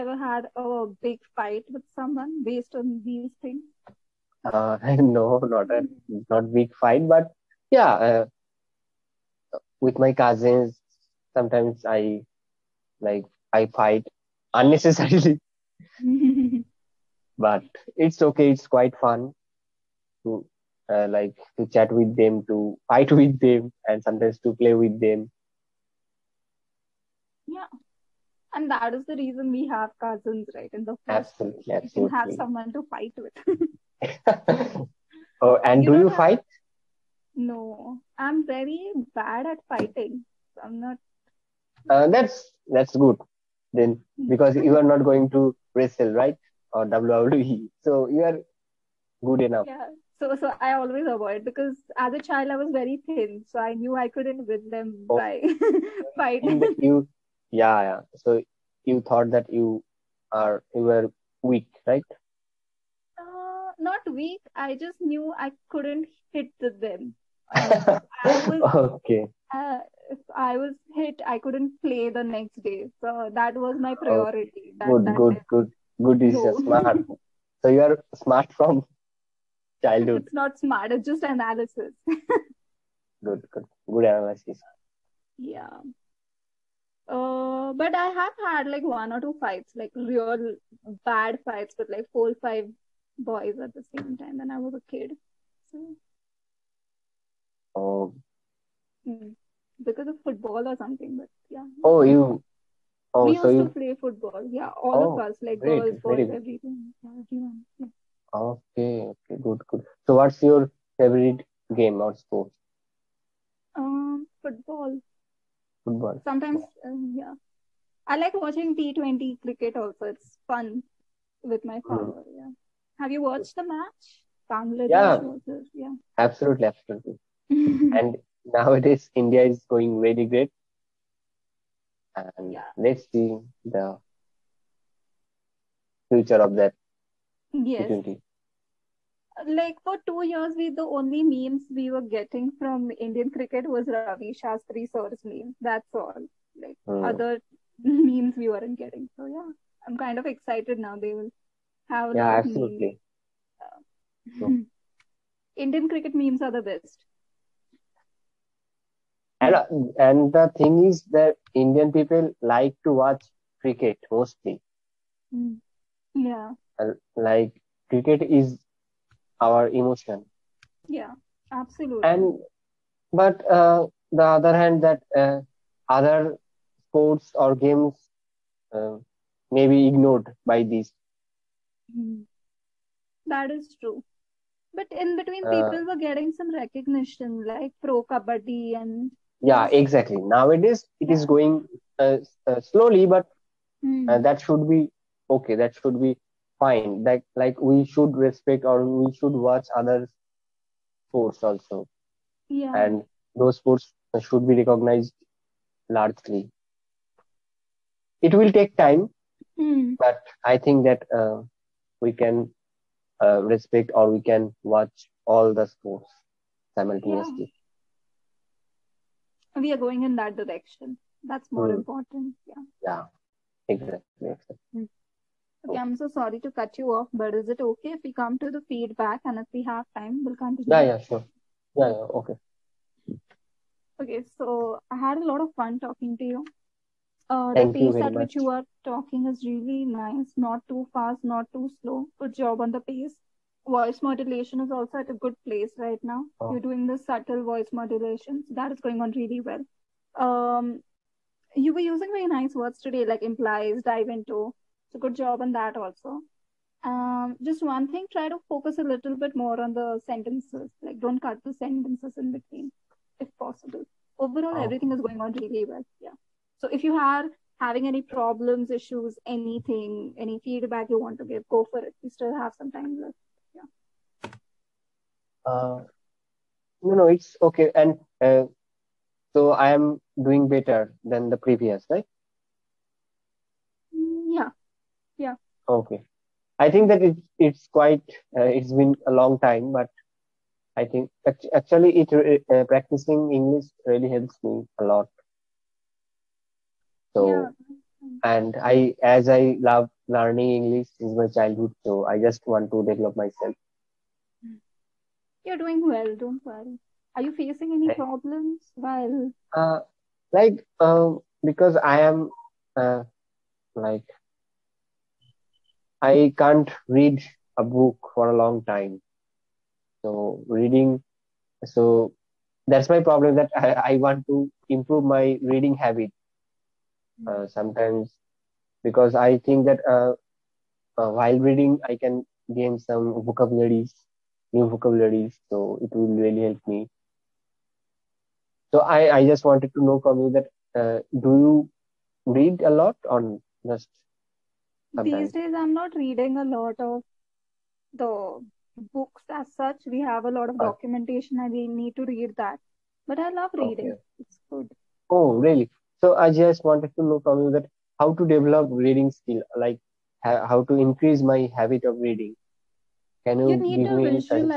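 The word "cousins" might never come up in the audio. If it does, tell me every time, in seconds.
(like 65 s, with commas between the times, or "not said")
10 s, 30 s.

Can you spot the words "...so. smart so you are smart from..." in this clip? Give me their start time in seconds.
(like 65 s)
76 s.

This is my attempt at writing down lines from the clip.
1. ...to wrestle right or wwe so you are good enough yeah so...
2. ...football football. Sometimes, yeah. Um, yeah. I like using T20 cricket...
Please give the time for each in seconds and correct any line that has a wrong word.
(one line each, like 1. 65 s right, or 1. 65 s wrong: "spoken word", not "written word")
1. 45 s right
2. 114 s wrong: "watching", not "using".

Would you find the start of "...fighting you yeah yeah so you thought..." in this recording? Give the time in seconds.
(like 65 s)
56 s.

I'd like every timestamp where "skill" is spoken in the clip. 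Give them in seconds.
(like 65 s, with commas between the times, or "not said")
359 s.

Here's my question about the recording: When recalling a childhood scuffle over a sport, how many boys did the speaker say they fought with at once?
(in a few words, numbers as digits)
4 or 5.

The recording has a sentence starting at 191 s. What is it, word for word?
going uh, uh, slowly but mm.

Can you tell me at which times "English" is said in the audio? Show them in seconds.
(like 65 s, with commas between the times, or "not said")
293 s, 300 s.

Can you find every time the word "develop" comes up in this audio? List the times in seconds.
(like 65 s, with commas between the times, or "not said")
302 s, 358 s.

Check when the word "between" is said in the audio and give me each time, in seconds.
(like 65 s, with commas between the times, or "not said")
185 s, 262 s.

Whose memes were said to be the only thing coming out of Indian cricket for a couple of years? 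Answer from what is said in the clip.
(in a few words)
Ravi Shastri.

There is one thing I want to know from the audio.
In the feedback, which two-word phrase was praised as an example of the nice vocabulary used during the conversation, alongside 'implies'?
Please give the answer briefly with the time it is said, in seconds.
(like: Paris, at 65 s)
dive into, at 253 s.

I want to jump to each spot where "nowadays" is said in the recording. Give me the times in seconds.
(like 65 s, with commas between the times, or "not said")
128 s, 190 s.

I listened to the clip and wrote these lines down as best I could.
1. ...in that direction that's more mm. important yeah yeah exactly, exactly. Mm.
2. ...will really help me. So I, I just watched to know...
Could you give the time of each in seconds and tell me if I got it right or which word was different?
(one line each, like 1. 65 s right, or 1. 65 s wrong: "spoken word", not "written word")
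1. 220 s right
2. 335 s wrong: "wanted", not "watched".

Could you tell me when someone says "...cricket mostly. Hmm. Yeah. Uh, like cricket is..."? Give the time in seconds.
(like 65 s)
163 s.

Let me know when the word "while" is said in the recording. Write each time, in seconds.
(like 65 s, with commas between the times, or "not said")
308 s, 331 s.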